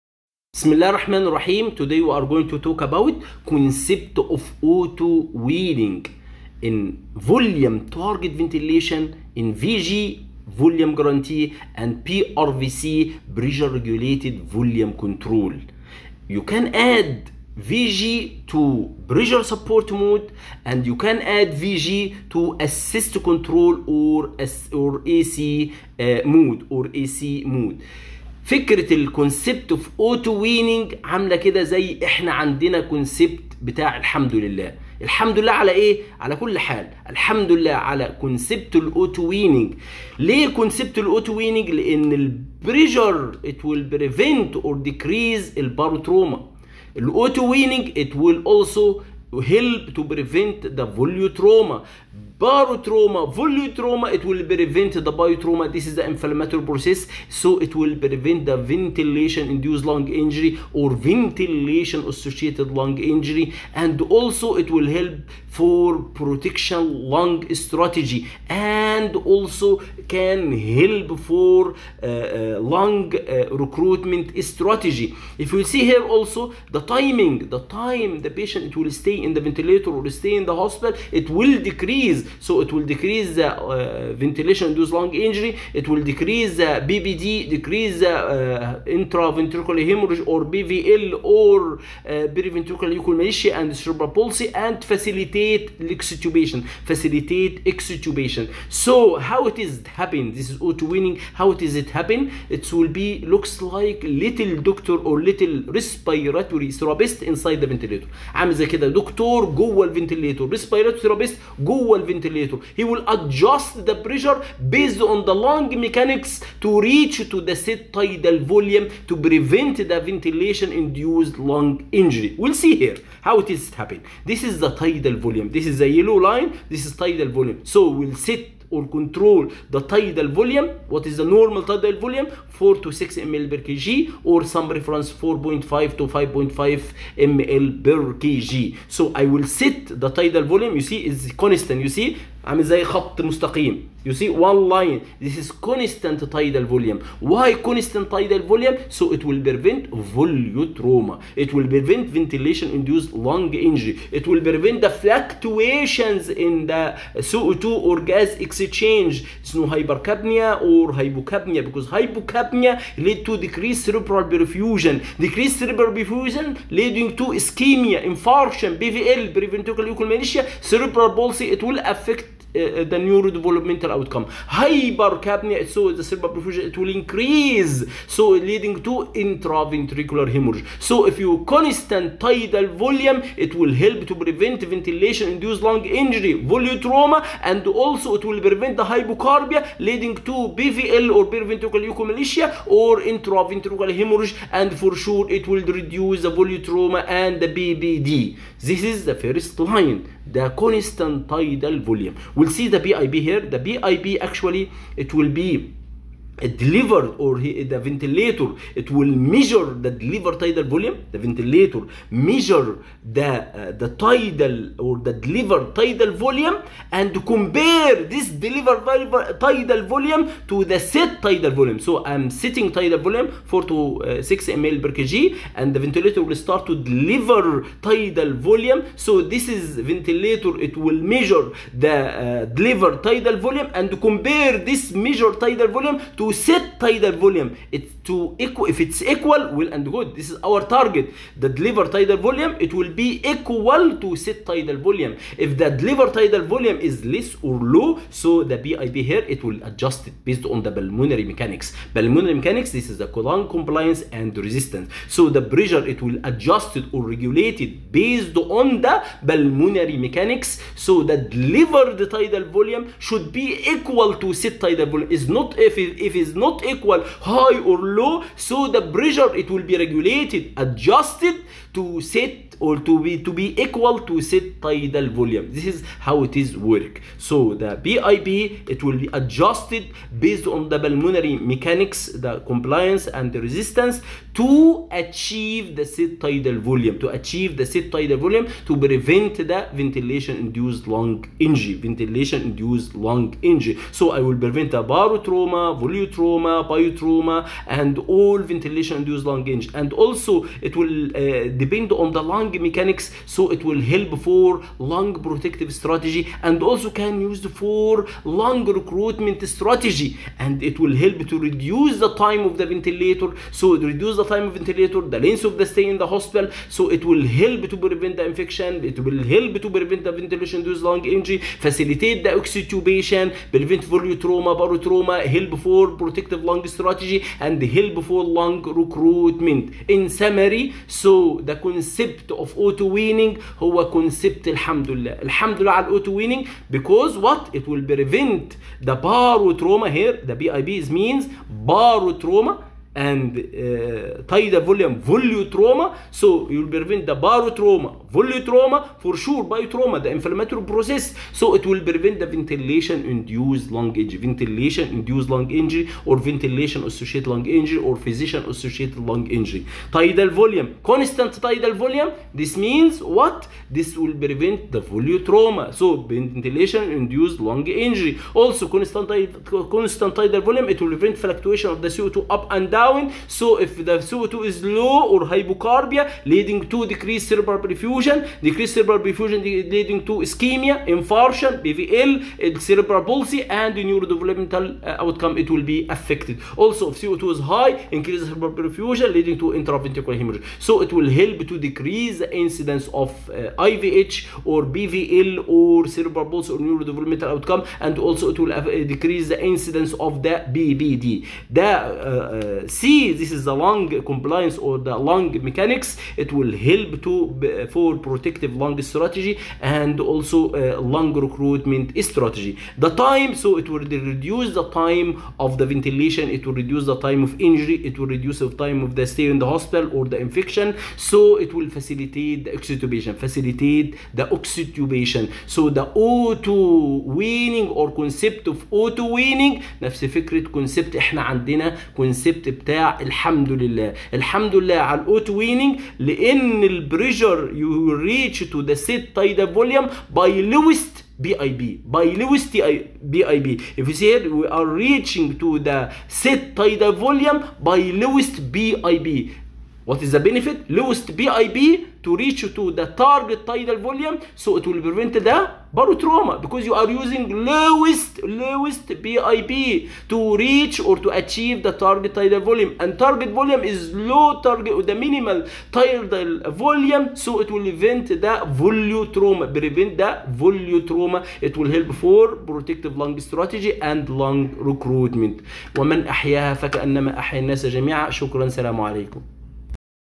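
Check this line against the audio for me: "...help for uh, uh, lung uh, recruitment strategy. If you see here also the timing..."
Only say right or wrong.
right.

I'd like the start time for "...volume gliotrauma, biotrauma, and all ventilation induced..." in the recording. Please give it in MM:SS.
04:55.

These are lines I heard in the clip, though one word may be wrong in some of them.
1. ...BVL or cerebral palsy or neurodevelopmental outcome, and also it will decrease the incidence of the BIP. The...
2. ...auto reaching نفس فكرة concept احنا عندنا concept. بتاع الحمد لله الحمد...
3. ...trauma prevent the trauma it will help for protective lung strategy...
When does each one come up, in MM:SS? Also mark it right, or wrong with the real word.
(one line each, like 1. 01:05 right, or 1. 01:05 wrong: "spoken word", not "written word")
1. 06:34 wrong: "BBD", not "BIP"
2. 07:08 wrong: "weaning", not "reaching"
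3. 07:49 right.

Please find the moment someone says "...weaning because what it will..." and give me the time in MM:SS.
05:36.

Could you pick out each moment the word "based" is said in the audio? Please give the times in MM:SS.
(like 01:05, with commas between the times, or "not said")
01:54, 04:10, 04:17, 04:40.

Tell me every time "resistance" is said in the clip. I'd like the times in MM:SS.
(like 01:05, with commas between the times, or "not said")
04:14, 04:43.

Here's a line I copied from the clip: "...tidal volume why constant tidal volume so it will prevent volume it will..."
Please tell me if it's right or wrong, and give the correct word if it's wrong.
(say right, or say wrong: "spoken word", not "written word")
right.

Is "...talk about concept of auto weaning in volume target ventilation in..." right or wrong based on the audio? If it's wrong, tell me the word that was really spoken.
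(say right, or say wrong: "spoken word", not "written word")
right.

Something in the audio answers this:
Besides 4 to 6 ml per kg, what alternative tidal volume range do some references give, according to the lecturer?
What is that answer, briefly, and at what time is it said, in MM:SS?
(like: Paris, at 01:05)
4.5 to 5.5 ml per kg, at 02:15.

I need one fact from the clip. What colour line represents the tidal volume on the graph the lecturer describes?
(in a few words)
yellow.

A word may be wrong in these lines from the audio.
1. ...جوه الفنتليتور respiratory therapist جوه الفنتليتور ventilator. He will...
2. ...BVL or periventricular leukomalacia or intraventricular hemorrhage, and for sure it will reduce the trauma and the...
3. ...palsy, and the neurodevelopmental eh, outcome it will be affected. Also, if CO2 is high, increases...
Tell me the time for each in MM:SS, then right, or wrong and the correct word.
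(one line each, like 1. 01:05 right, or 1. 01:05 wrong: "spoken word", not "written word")
1. 01:49 right
2. 03:10 right
3. 06:23 right.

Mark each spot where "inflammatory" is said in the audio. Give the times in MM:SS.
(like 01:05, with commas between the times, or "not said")
00:56, 05:50.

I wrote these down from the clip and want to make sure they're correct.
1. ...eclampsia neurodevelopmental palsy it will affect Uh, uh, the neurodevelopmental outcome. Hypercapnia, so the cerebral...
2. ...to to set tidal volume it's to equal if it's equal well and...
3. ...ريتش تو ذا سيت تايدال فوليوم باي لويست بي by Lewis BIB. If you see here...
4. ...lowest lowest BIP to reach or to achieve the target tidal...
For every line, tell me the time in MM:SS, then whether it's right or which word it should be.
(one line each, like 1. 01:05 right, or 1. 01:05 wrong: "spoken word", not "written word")
1. 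02:49 wrong: "cerebral", not "neurodevelopmental"
2. 03:56 right
3. 07:17 right
4. 07:37 right.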